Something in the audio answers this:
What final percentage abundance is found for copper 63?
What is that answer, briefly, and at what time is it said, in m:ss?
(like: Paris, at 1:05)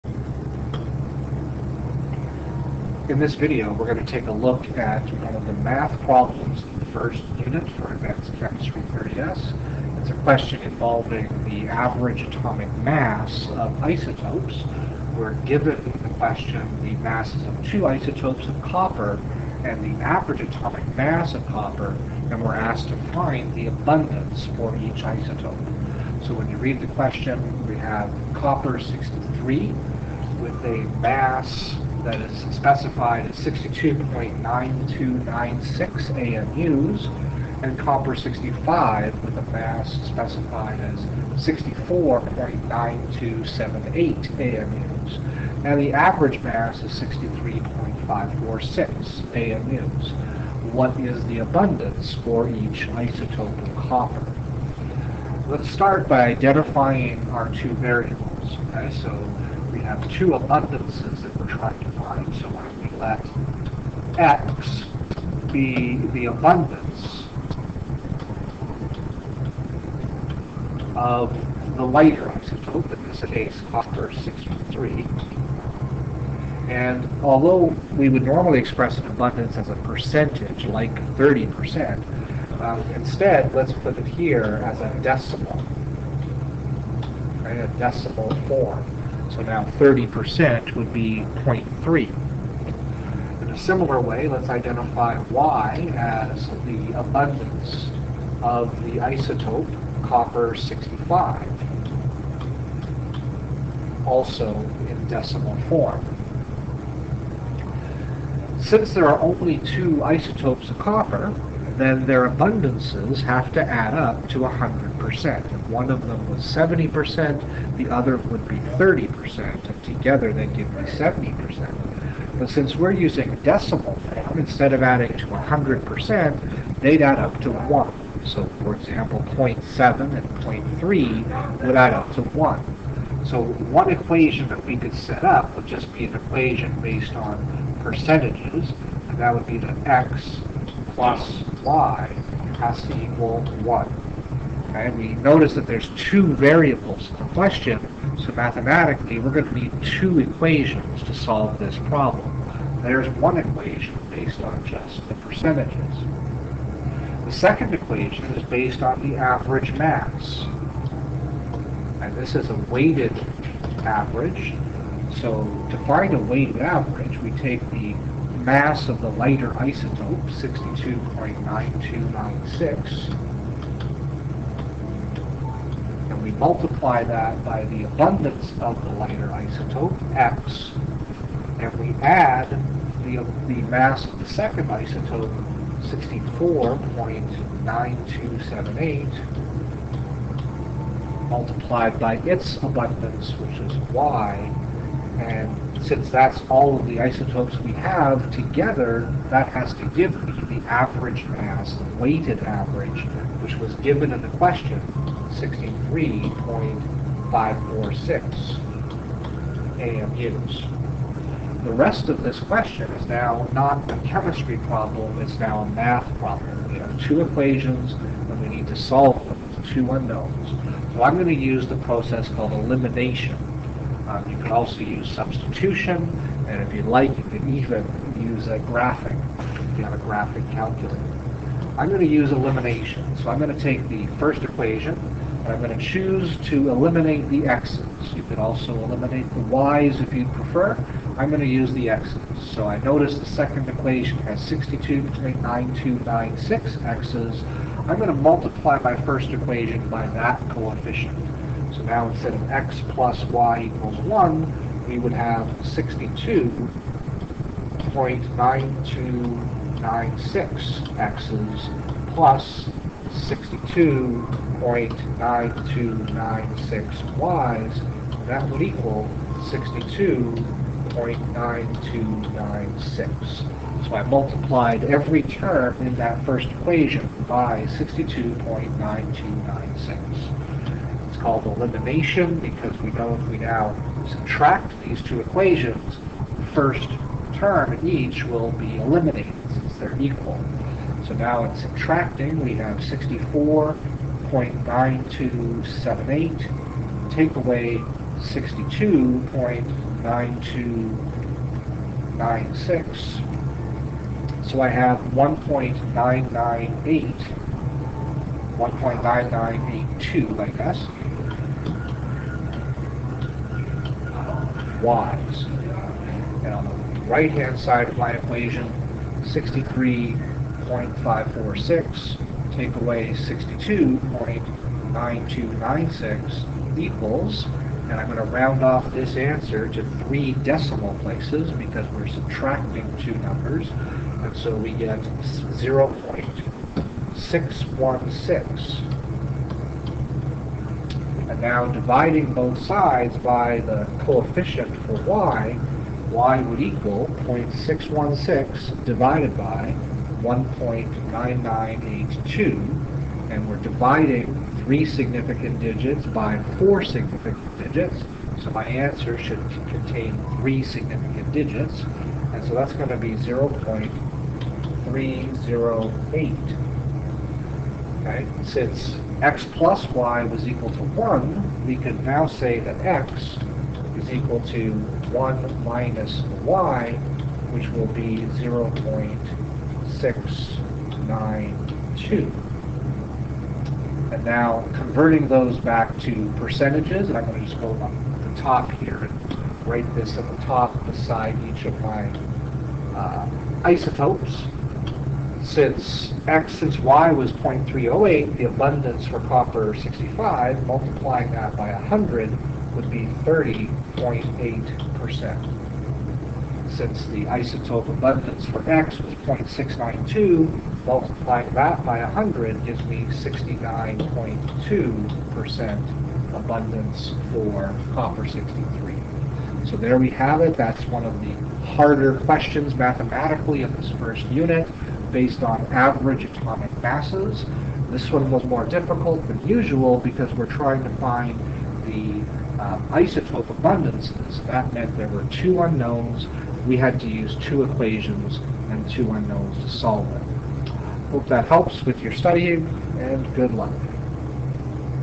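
69.2%, at 6:53.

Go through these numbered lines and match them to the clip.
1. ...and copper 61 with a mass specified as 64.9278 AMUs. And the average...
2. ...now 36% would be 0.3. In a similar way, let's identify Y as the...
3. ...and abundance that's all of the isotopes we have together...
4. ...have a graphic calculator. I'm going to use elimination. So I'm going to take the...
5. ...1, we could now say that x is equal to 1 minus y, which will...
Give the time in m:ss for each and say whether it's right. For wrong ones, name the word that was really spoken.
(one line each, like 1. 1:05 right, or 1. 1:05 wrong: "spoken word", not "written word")
1. 0:37 wrong: "65", not "61"
2. 1:29 wrong: "30", not "36"
3. 3:15 wrong: "since", not "abundance"
4. 3:49 right
5. 6:10 right.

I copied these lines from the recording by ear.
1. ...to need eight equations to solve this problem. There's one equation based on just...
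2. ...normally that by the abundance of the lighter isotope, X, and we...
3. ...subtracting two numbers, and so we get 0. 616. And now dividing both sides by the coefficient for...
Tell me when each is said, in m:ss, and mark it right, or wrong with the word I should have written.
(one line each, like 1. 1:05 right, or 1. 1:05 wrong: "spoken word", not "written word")
1. 2:29 wrong: "two", not "eight"
2. 2:56 wrong: "multiply", not "normally"
3. 5:32 right.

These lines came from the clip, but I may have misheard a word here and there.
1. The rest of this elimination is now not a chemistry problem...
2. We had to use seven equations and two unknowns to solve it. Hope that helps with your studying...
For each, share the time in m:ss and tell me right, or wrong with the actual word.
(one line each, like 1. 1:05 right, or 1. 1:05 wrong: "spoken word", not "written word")
1. 3:31 wrong: "question", not "elimination"
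2. 7:16 wrong: "two", not "seven".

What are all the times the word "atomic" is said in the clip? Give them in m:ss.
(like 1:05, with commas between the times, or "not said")
0:12, 0:20, 7:06.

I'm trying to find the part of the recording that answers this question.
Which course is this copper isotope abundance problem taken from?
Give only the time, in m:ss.
0:07.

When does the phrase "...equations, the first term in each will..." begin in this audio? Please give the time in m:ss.
4:45.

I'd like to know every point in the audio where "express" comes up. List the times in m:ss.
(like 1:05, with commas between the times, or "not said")
1:18.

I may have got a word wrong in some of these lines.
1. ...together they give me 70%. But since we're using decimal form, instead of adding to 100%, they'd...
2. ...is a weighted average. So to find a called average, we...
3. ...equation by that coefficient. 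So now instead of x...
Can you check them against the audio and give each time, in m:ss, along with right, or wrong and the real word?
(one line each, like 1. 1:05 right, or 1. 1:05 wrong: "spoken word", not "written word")
1. 1:59 right
2. 2:42 wrong: "weighted", not "called"
3. 4:09 right.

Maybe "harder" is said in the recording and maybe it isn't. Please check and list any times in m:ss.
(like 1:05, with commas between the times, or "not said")
7:01.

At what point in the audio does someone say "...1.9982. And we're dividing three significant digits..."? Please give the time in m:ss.
5:50.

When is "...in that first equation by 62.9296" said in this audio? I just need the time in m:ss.
4:35.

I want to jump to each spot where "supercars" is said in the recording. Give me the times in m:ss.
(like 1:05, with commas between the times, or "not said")
not said.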